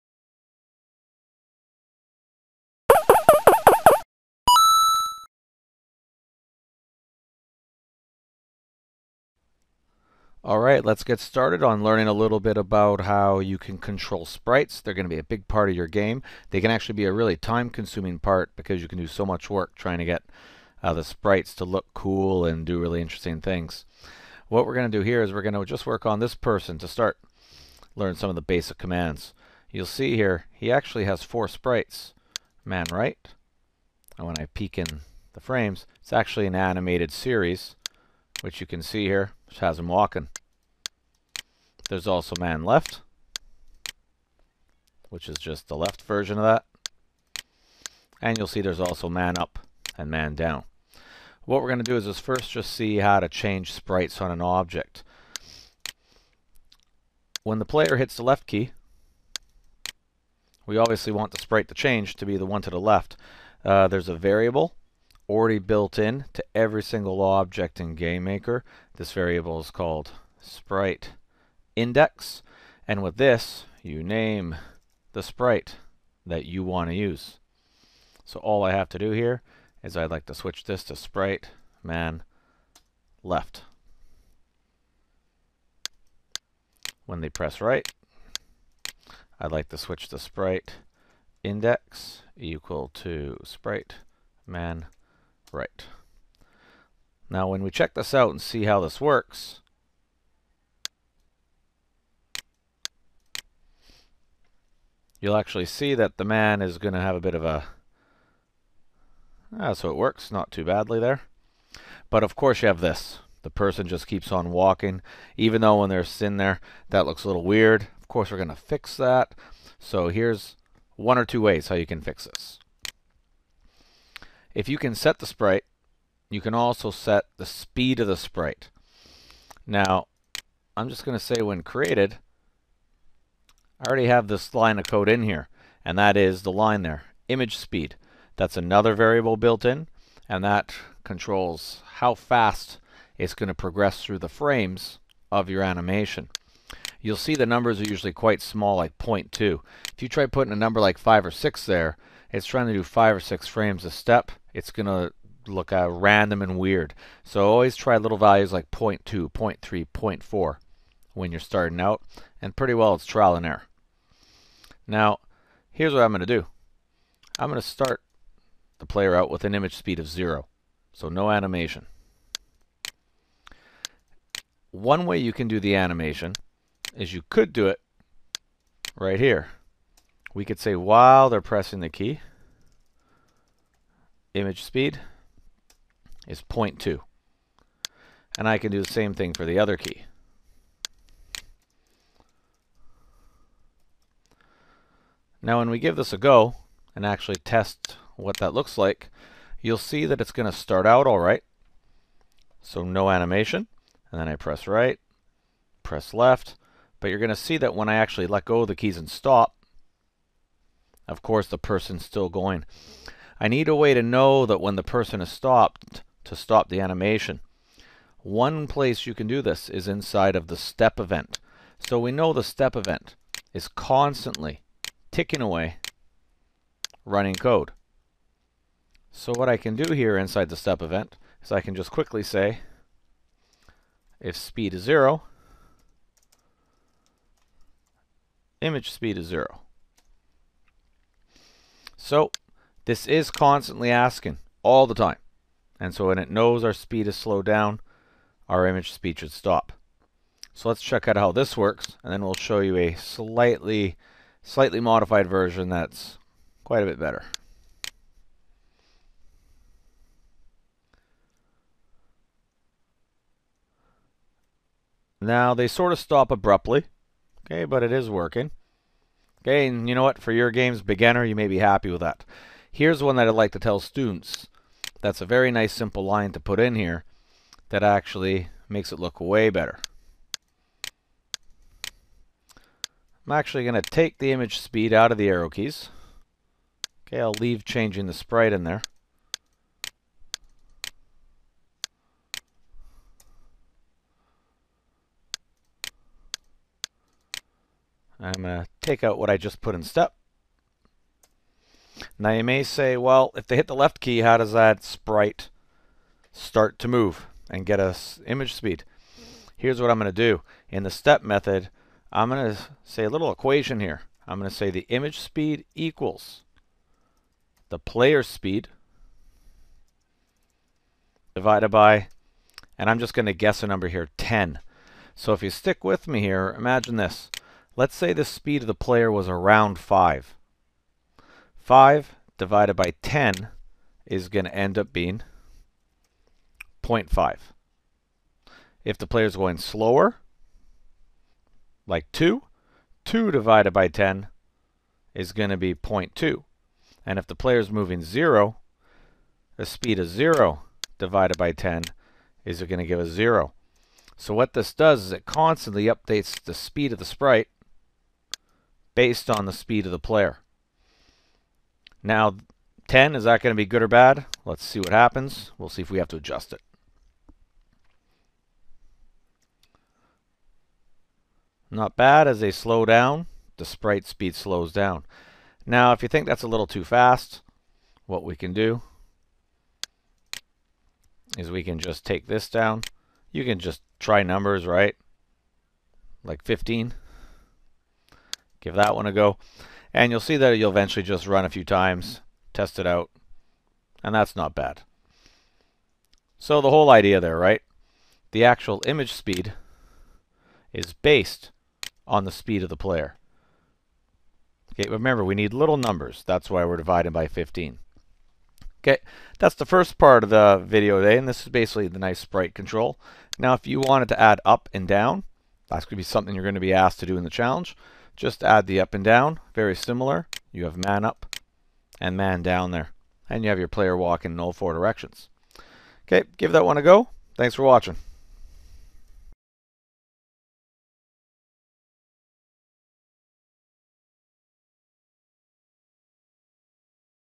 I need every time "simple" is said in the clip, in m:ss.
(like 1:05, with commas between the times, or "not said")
4:35.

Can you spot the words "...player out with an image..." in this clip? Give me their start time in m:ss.
2:48.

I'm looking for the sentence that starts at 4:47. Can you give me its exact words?
Okay, I'll leave changing the sprite in there.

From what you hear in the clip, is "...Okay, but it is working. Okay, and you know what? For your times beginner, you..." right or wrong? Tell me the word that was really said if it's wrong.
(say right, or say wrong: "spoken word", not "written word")
wrong: "games", not "times".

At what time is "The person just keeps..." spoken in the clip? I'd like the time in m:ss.
1:53.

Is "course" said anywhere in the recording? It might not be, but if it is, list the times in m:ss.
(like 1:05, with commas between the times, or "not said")
1:52, 1:58, 3:31.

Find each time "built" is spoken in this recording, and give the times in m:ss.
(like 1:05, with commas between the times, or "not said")
1:05, 2:19.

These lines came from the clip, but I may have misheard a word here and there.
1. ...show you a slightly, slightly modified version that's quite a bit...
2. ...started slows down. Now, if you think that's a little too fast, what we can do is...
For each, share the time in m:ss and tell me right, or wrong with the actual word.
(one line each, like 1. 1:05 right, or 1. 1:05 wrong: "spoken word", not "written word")
1. 4:12 right
2. 6:14 wrong: "speed", not "started".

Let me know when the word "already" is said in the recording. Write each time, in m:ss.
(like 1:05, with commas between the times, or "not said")
1:05, 2:13.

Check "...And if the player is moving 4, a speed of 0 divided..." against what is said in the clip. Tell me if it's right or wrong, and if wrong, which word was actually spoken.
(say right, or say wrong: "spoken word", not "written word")
wrong: "0", not "4".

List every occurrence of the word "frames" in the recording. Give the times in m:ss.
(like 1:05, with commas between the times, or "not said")
0:35, 2:24, 2:33.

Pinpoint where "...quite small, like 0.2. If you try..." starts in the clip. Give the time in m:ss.
2:28.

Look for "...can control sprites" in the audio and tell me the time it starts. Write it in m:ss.
0:13.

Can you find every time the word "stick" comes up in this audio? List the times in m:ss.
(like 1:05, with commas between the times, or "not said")
5:25.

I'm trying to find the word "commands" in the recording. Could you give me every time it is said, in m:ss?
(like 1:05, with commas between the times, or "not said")
0:28.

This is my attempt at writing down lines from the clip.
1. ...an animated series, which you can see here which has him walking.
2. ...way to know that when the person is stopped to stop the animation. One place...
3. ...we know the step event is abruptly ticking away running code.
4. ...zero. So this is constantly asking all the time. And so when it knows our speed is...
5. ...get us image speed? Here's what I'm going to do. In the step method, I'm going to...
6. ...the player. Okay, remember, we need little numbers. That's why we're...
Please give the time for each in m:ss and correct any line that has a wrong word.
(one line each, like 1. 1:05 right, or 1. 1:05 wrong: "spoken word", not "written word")
1. 0:36 right
2. 3:33 right
3. 3:41 wrong: "constantly", not "abruptly"
4. 3:59 right
5. 5:07 right
6. 6:42 right.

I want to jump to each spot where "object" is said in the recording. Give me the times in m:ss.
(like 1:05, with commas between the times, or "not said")
0:54, 1:07.